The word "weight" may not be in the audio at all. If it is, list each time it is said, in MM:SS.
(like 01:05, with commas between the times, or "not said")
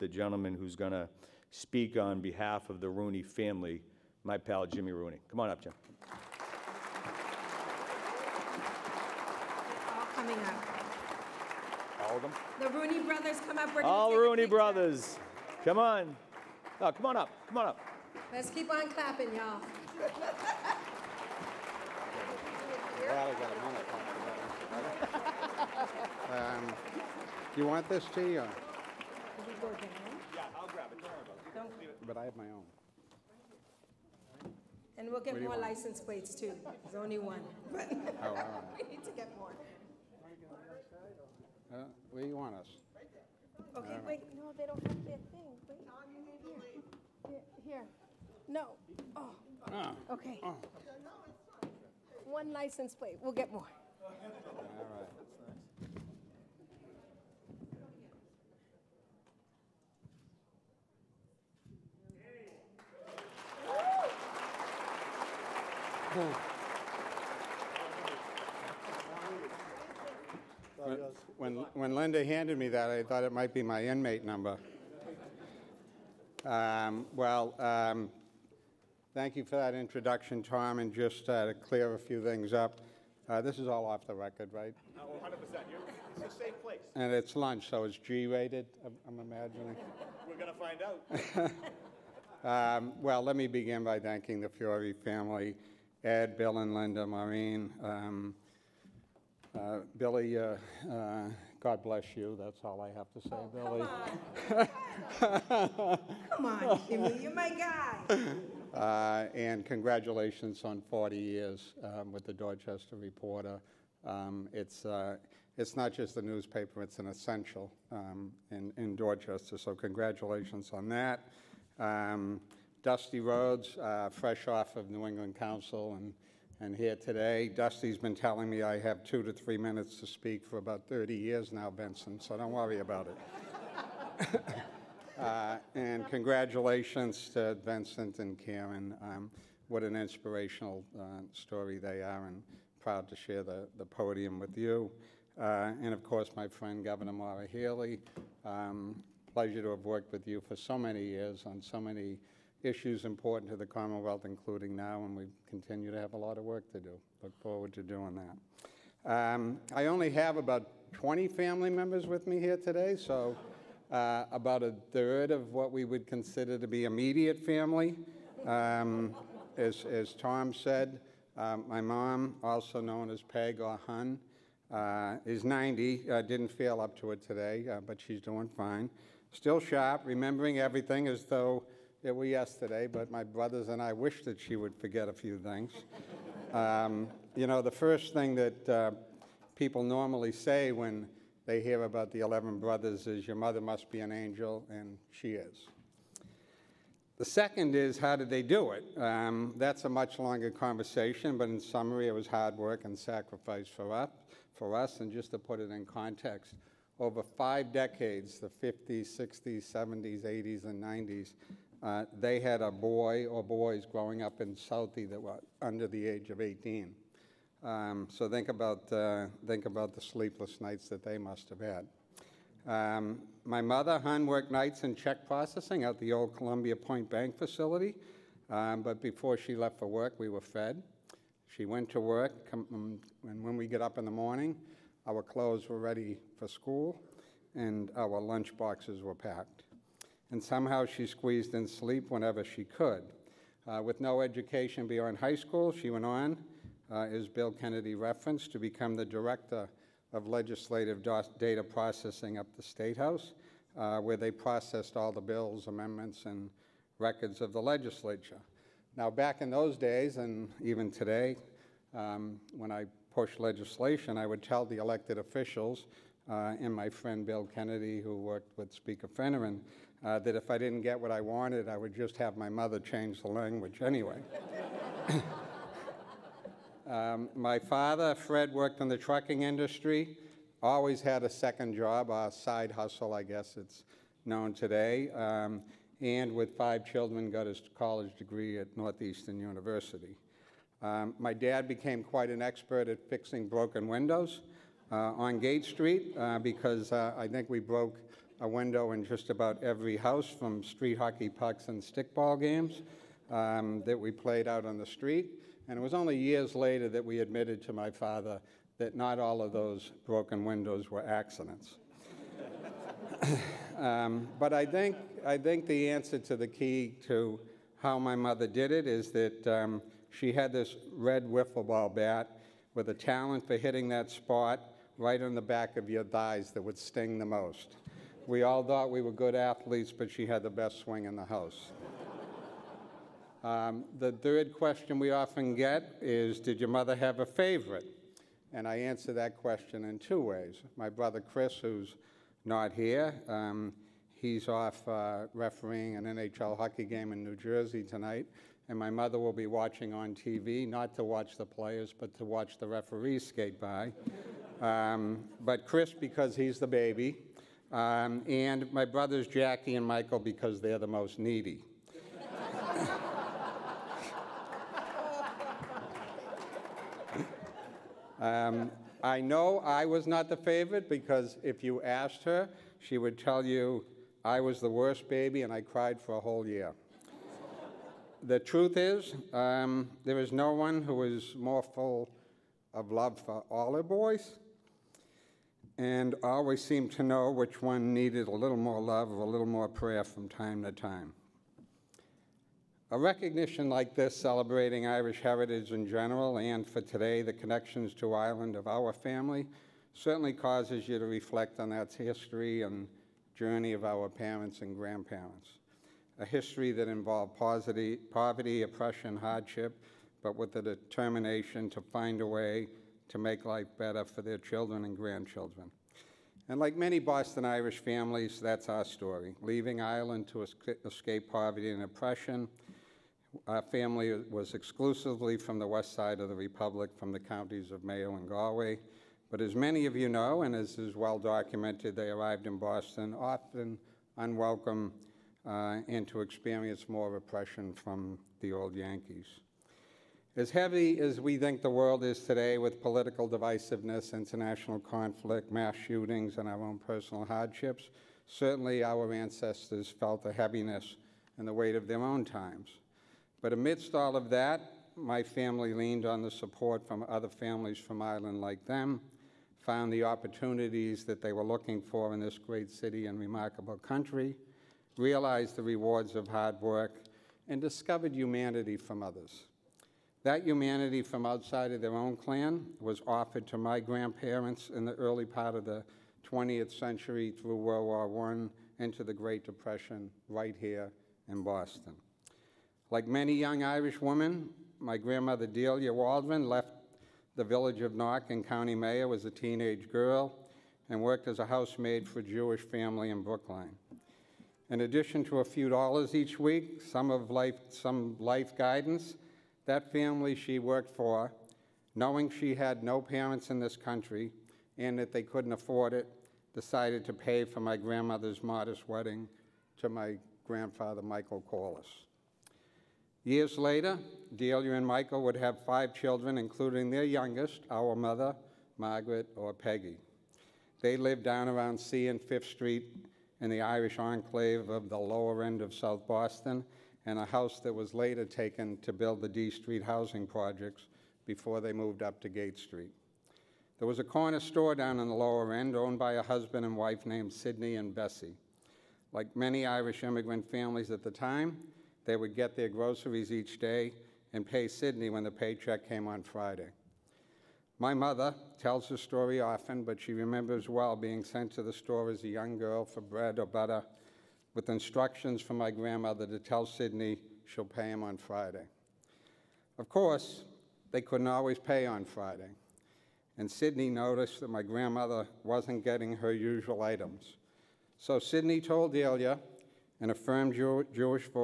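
07:31.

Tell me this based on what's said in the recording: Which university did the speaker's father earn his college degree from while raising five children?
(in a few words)
Northeastern University.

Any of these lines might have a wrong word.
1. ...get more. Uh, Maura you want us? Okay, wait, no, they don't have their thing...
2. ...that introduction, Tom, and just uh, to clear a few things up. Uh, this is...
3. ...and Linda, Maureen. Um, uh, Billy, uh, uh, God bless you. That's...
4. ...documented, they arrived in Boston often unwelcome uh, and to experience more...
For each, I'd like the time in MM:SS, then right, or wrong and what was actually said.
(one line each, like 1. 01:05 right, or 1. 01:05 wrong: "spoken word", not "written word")
1. 00:39 wrong: "Where", not "Maura"
2. 01:19 right
3. 01:36 right
4. 07:11 right.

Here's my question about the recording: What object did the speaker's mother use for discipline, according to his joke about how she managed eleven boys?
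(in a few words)
red wiffle ball bat.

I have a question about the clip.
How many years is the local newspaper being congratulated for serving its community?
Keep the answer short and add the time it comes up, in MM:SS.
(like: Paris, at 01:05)
40, at 01:50.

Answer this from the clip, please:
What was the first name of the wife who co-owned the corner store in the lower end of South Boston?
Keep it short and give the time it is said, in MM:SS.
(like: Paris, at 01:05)
Bessie, at 08:57.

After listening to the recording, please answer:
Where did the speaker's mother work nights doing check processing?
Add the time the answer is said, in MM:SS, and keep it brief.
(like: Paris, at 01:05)
Columbia Point Bank, at 03:46.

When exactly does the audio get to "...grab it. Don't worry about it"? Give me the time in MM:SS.
00:30.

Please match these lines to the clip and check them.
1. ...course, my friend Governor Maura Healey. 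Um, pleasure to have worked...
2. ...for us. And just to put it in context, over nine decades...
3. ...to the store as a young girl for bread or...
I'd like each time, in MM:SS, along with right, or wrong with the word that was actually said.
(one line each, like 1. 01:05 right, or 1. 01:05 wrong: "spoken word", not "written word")
1. 02:26 right
2. 03:24 wrong: "five", not "nine"
3. 09:11 right.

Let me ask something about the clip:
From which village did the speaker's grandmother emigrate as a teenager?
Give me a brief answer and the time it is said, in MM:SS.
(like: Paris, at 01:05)
Knock, at 08:07.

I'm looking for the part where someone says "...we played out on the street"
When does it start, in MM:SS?
05:03.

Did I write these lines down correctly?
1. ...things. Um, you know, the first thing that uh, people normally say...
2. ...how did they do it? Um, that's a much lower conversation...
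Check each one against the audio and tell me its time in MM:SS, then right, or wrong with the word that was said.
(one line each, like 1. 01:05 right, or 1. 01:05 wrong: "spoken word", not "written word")
1. 03:05 right
2. 03:17 wrong: "longer", not "lower".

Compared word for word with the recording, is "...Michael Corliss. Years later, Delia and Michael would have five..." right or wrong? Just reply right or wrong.
right.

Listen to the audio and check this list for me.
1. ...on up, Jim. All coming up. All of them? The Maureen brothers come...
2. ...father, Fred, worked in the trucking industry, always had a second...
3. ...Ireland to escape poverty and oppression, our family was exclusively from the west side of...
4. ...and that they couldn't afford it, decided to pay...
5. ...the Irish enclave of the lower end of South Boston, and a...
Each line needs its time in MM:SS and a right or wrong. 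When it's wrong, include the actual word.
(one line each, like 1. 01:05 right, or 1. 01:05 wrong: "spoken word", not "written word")
1. 00:05 wrong: "Rooney", not "Maureen"
2. 04:37 right
3. 06:59 right
4. 08:24 right
5. 08:43 right.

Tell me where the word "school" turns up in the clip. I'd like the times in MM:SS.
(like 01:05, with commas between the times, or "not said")
03:56, 04:05.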